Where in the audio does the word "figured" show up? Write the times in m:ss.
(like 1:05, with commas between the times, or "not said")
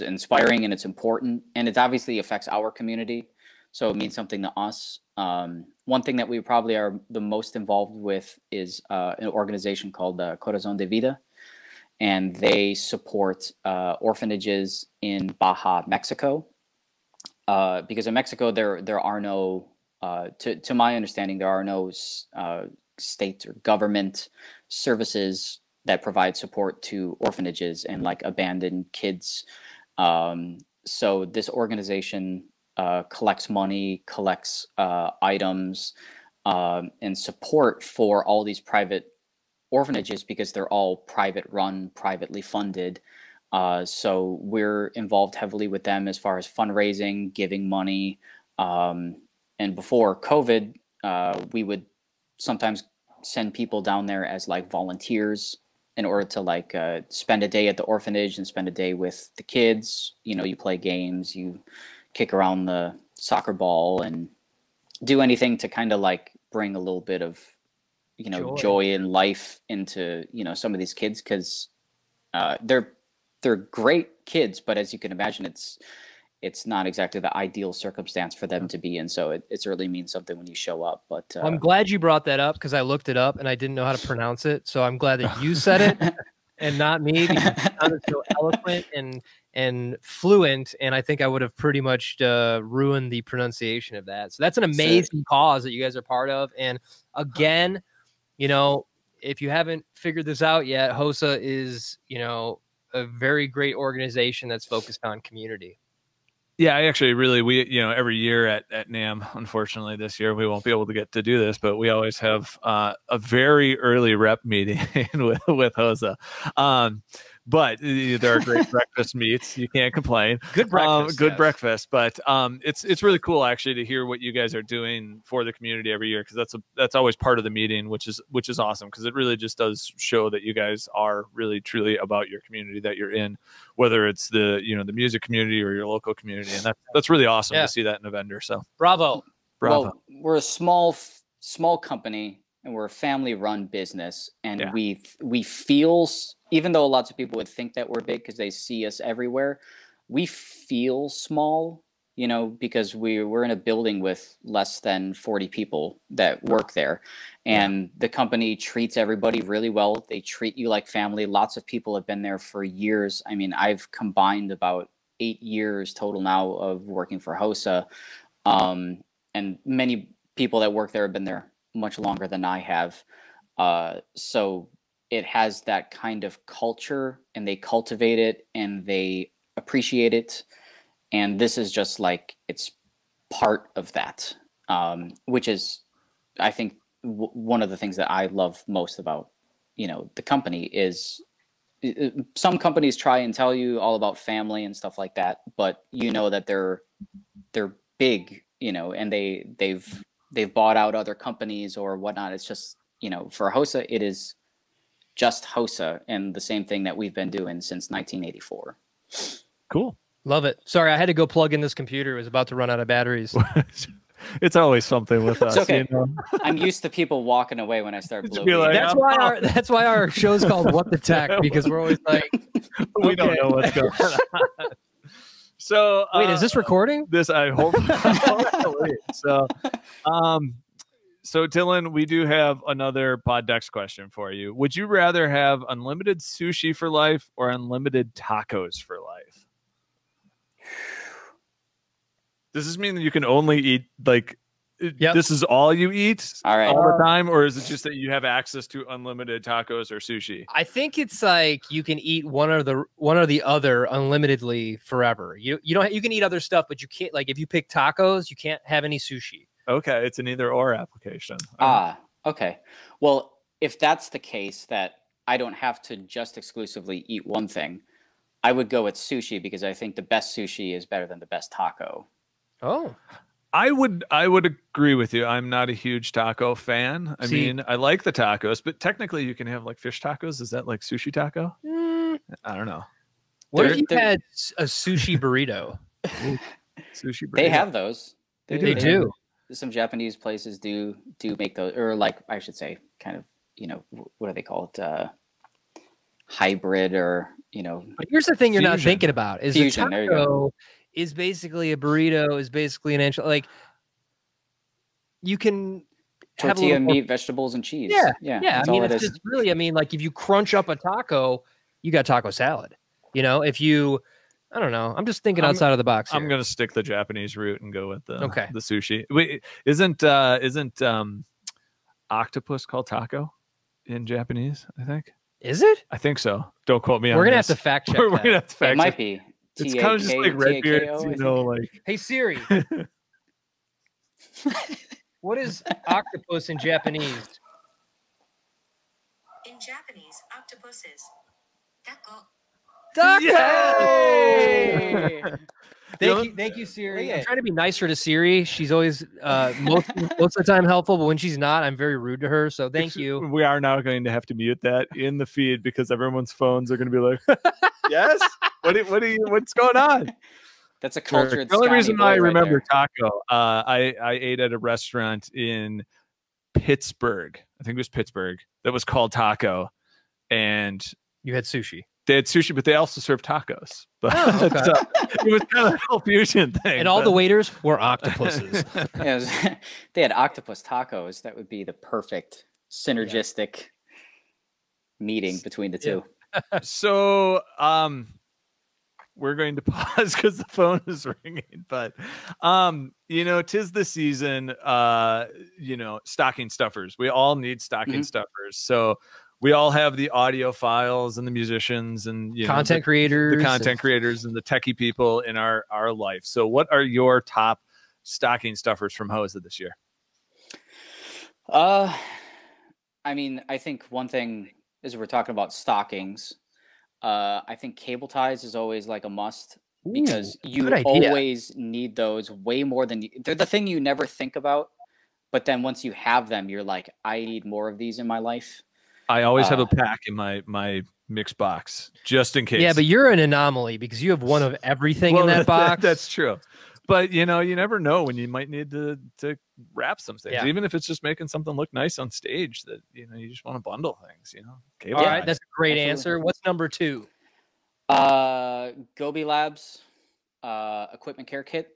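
1:39.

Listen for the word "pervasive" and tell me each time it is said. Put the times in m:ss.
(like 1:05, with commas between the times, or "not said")
not said.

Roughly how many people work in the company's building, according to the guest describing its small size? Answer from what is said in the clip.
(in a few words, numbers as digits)
Less than 40.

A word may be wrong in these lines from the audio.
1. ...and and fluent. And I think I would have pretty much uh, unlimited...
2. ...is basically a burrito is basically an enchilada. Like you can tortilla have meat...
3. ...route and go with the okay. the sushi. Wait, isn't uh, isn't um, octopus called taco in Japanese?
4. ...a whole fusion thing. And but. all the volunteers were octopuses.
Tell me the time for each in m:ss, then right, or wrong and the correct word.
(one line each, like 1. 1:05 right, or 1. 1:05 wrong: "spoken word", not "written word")
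1. 1:28 wrong: "ruined", not "unlimited"
2. 5:00 right
3. 5:17 right
4. 6:15 wrong: "waiters", not "volunteers".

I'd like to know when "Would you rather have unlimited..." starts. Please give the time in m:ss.
3:54.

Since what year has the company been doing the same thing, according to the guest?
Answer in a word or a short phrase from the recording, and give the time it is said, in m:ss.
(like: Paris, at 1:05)
1984, at 3:27.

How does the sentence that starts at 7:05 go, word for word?
But then once you have them, you're like, I need more of these in my life.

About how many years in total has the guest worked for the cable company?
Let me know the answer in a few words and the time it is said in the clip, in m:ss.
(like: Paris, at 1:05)
About 8 years, at 2:44.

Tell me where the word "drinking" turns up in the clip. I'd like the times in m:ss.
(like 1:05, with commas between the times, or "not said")
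not said.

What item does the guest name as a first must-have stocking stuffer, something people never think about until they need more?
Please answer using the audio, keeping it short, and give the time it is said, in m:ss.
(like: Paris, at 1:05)
Cable ties, at 6:57.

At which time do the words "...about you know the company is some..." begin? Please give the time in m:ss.
3:08.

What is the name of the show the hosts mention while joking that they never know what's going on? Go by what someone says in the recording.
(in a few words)
What the Tech.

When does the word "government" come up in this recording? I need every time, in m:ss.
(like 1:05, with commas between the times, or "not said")
0:23.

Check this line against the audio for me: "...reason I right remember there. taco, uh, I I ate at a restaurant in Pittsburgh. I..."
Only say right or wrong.
right.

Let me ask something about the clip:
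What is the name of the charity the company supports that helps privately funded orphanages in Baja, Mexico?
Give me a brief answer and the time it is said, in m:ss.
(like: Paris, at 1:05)
Corazon de Vida, at 0:10.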